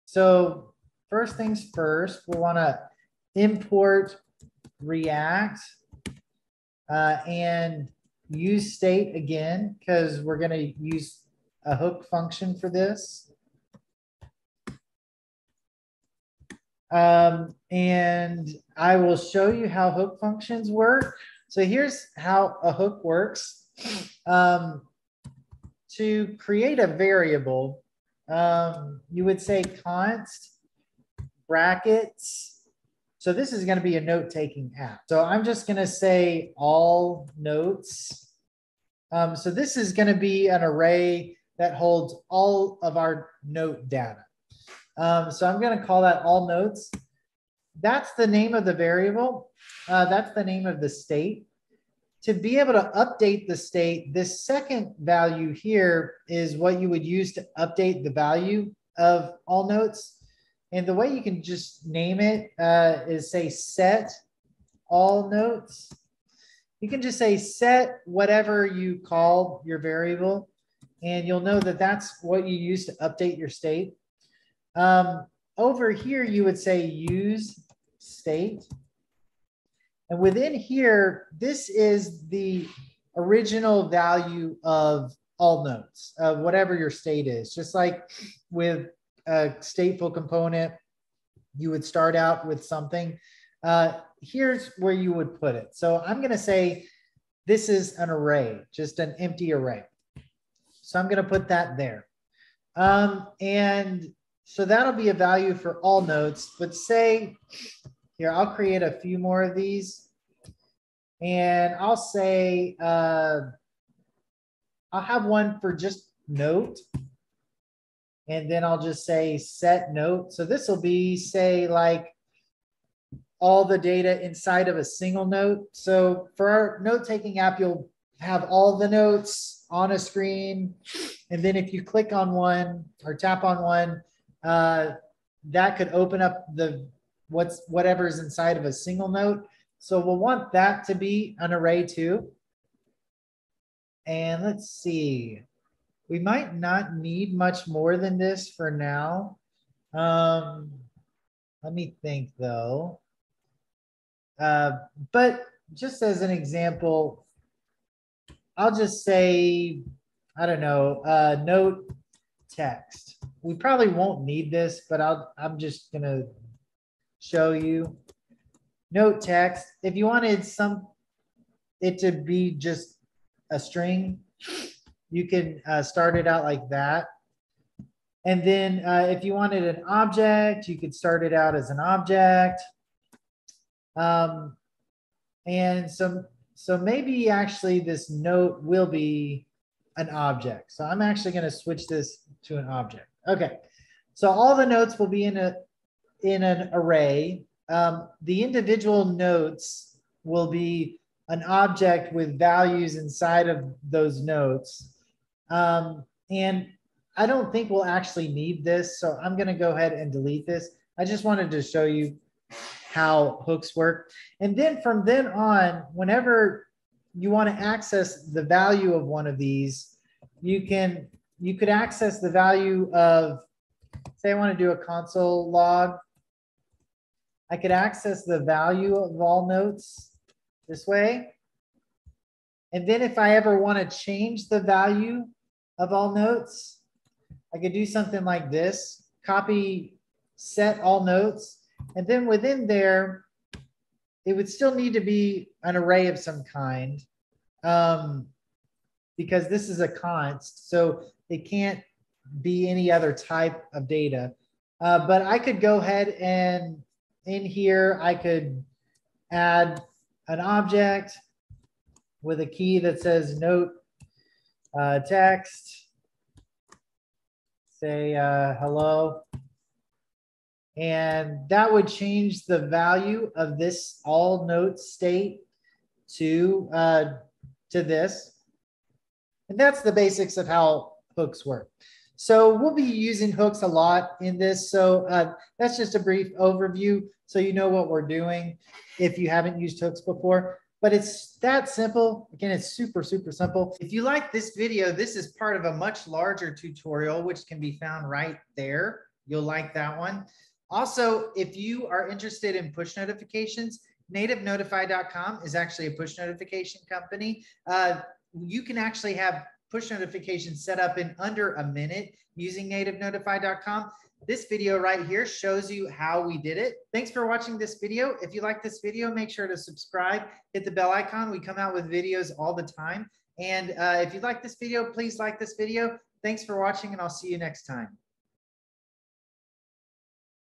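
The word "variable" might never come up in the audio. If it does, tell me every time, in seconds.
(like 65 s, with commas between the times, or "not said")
26 s, 48 s, 69 s.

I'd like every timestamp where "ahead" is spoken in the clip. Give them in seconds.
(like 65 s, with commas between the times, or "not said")
209 s, 255 s.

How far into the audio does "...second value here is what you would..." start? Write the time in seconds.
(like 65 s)
54 s.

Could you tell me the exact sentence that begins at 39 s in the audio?
Um, so this is going to be an array that holds all of our note data.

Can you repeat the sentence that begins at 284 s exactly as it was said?
So uh, that's just a brief overview so you know what we're doing if you haven't used hooks before.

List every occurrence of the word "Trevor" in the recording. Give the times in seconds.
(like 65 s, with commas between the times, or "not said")
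not said.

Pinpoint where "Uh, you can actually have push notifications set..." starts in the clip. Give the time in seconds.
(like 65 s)
307 s.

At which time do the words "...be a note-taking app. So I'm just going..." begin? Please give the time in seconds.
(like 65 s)
33 s.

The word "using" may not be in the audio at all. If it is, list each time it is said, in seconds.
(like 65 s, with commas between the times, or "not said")
282 s, 312 s.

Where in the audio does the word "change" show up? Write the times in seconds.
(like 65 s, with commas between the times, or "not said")
233 s, 271 s.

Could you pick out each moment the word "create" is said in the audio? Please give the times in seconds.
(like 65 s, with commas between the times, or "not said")
26 s, 108 s.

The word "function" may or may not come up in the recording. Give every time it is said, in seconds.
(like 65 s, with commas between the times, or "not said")
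12 s, 20 s.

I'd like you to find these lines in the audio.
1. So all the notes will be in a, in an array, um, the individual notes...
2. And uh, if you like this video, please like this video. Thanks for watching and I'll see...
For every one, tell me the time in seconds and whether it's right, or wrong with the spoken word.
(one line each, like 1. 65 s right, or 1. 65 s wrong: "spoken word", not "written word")
1. 194 s right
2. 323 s right.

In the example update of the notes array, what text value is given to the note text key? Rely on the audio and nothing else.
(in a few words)
hello.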